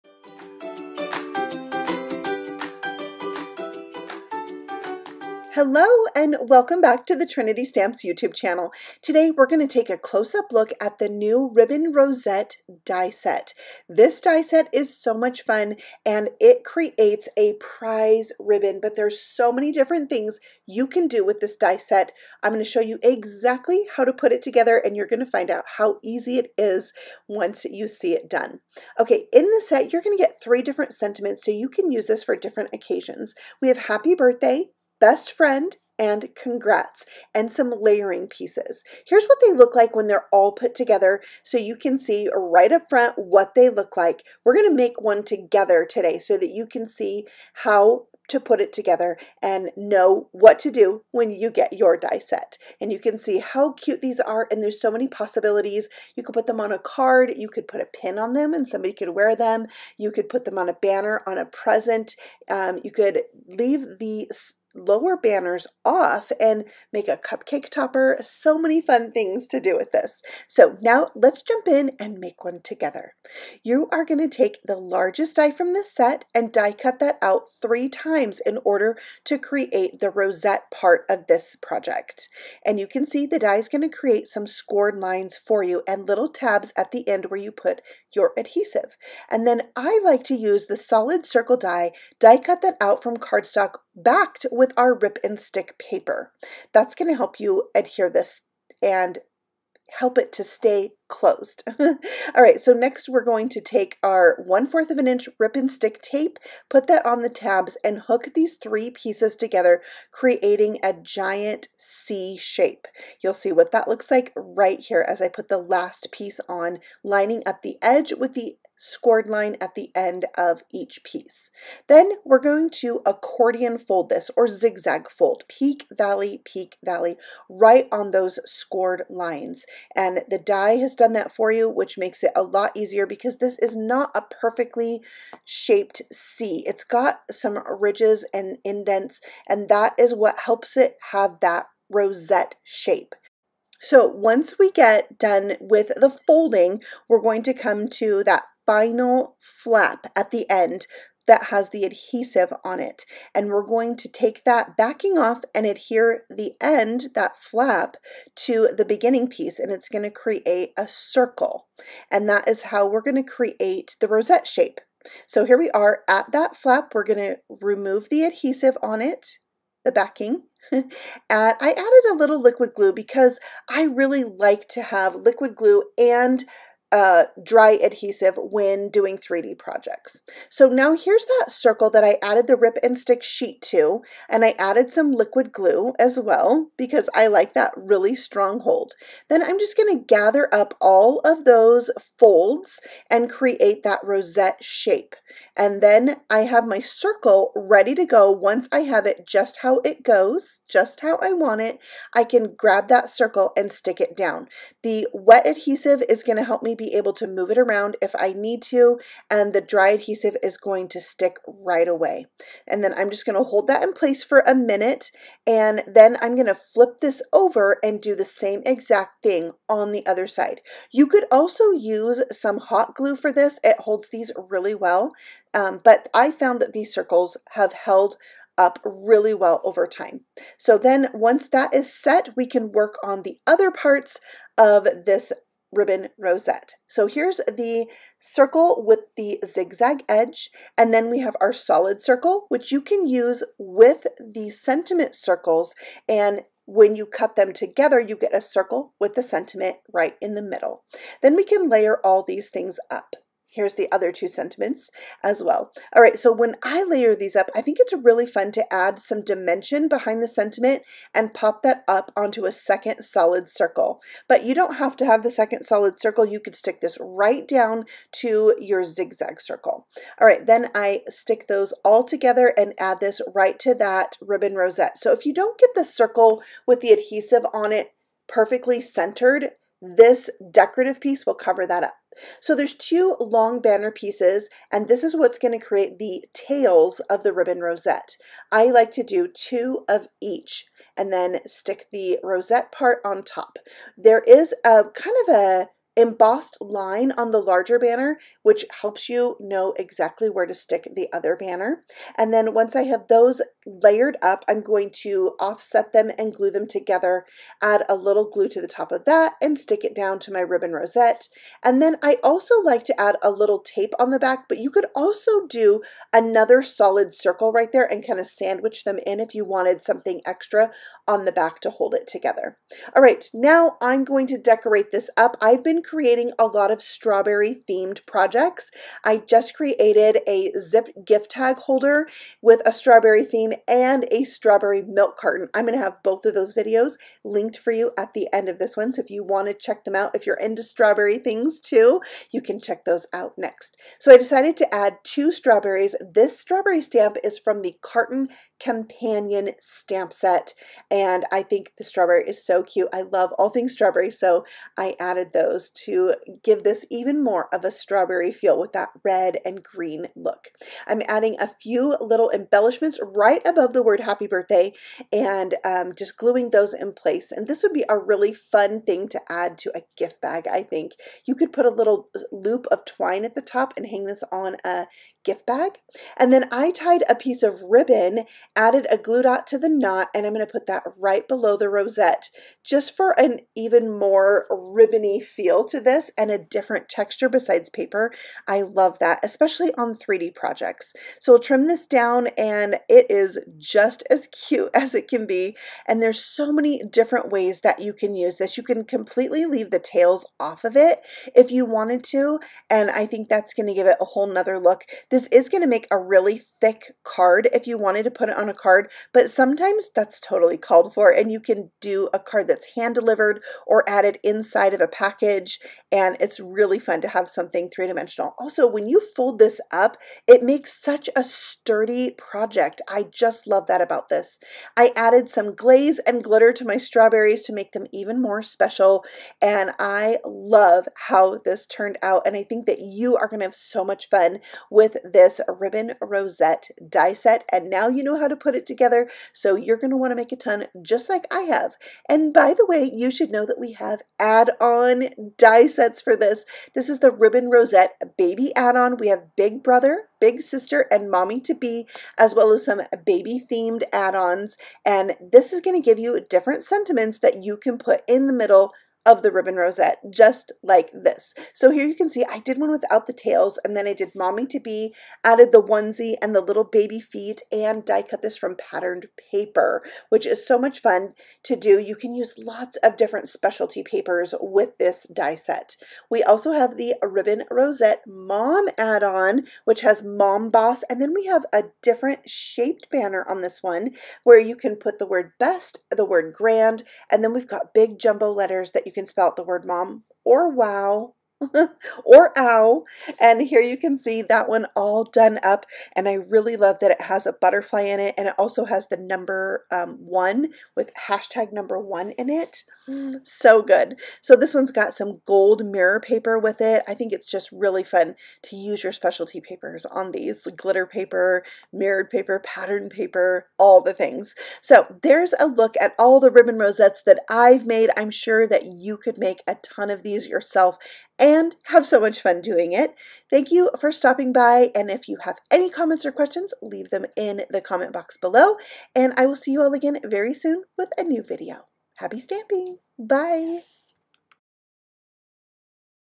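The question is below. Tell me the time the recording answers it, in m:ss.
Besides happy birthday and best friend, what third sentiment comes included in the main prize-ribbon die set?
0:36.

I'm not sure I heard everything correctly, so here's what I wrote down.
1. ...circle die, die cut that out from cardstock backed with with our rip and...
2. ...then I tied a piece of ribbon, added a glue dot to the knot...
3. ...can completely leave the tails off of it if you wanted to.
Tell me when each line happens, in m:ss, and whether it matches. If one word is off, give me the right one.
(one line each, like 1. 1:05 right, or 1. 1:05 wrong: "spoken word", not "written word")
1. 1:31 right
2. 6:16 right
3. 6:38 right.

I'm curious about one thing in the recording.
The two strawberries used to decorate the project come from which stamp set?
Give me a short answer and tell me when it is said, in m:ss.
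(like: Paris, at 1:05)
Carton companion, at 5:47.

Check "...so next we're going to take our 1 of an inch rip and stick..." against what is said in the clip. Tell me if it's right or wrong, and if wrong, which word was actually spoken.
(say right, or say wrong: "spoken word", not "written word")
right.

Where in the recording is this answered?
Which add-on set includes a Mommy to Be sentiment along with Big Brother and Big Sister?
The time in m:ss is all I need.
7:27.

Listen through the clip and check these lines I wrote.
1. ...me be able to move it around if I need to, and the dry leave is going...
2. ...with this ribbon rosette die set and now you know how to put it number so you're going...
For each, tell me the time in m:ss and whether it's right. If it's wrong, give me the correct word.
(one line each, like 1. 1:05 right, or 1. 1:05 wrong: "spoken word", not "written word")
1. 3:26 wrong: "adhesive", not "leave"
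2. 7:14 wrong: "together", not "number".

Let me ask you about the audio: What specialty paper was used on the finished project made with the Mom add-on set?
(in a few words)
gold mirror paper.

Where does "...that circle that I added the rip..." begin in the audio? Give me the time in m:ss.
3:01.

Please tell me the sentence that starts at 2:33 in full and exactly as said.
And we're going to take that backing off and adhere the end, that flap, to the beginning piece.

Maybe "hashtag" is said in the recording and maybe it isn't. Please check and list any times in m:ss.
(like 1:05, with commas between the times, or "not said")
8:21.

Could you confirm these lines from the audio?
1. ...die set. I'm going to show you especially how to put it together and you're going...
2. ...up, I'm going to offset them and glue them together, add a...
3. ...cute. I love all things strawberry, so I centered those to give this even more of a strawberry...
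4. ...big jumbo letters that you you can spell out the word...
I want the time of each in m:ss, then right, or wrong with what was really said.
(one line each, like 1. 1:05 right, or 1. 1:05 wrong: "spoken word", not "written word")
1. 0:21 wrong: "exactly", not "especially"
2. 5:04 right
3. 5:52 wrong: "added", not "centered"
4. 8:07 right.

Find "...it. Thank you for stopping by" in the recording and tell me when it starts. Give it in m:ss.
8:42.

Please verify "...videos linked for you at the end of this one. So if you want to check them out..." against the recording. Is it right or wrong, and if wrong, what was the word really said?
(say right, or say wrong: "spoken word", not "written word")
right.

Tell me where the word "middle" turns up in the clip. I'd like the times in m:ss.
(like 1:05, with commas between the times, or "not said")
4:10, 7:38.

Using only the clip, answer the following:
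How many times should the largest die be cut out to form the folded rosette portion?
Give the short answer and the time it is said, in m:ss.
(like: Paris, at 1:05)
3, at 1:17.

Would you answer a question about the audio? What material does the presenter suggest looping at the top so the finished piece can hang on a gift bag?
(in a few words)
twine.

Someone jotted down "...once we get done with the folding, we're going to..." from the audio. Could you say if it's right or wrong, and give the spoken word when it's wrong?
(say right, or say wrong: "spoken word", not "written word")
right.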